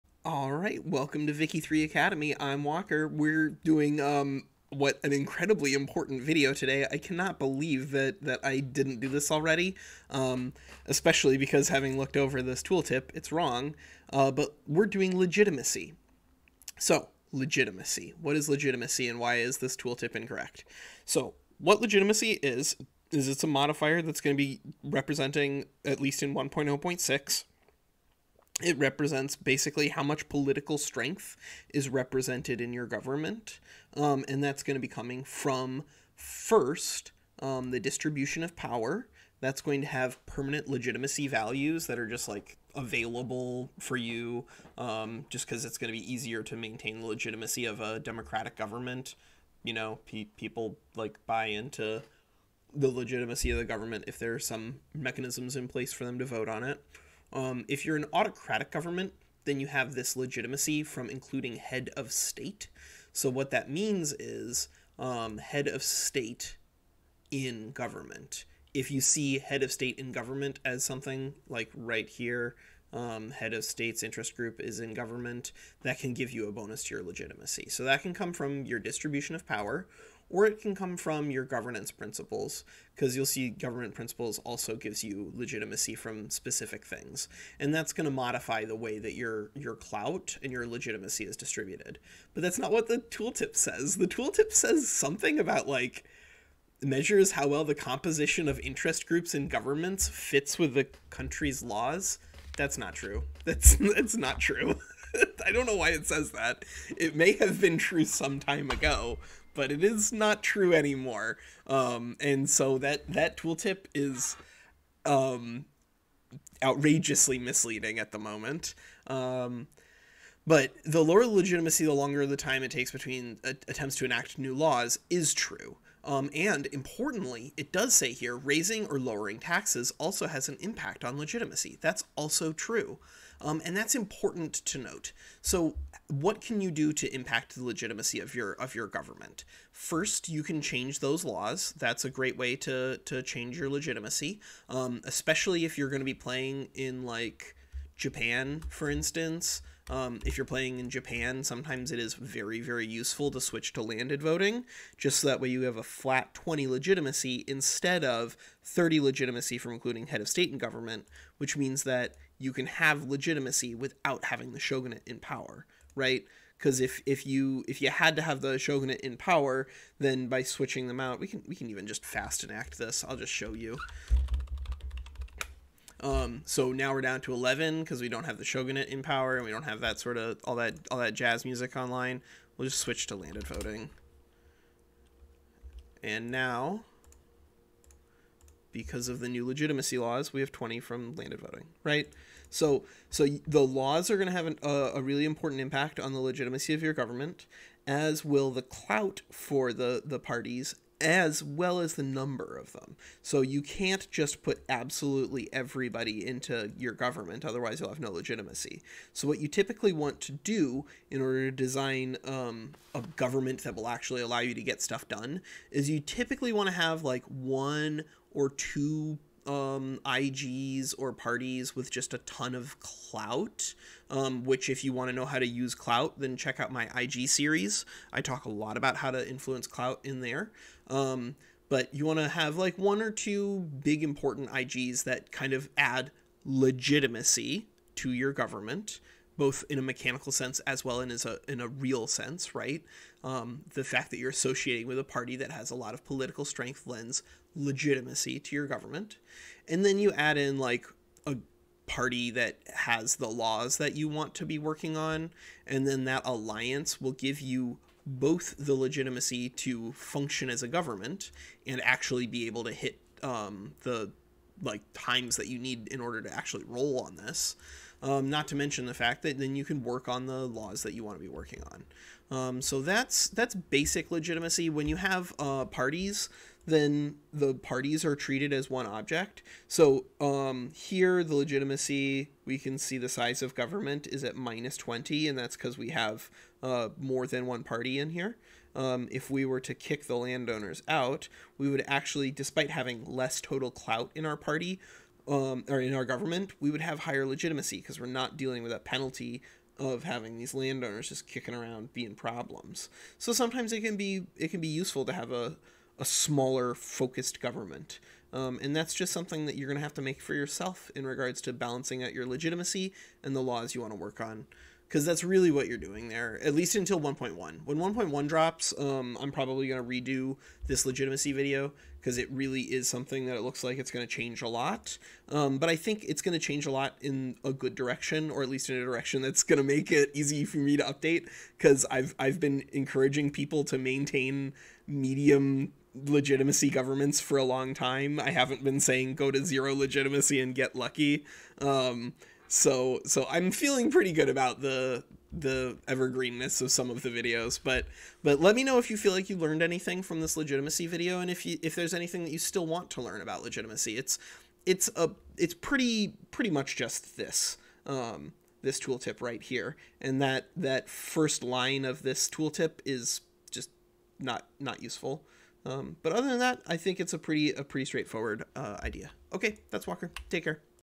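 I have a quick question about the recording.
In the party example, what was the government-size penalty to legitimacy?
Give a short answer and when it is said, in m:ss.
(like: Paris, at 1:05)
-20, at 4:44.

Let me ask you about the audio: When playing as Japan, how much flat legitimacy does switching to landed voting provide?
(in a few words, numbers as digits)
20.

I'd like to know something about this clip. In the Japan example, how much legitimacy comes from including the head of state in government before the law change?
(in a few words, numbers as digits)
30.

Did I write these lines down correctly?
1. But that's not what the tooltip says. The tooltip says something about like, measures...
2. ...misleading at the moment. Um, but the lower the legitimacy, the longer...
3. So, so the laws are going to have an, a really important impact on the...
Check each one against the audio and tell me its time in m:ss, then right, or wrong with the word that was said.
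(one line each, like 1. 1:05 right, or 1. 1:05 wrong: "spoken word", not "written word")
1. 1:32 right
2. 1:57 right
3. 3:12 right.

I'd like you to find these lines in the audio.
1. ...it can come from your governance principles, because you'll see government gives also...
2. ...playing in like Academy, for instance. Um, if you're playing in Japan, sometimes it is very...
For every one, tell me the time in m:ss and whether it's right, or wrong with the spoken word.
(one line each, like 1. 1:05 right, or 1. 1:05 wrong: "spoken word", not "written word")
1. 1:20 wrong: "principles", not "gives"
2. 2:26 wrong: "Japan", not "Academy".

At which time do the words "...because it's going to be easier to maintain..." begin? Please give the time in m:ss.
0:45.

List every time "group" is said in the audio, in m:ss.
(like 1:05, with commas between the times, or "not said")
1:14, 1:39.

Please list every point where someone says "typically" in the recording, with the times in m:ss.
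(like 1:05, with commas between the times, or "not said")
3:29, 3:35.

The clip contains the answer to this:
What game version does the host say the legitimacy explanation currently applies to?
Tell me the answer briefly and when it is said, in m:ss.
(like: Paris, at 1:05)
1.0.6, at 0:26.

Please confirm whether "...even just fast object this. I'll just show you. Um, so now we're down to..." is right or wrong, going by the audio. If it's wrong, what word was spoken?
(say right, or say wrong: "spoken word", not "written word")
wrong: "enact", not "object".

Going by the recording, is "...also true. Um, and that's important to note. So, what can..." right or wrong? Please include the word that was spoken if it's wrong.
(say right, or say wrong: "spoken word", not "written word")
right.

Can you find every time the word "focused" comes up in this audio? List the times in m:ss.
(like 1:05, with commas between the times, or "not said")
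5:06.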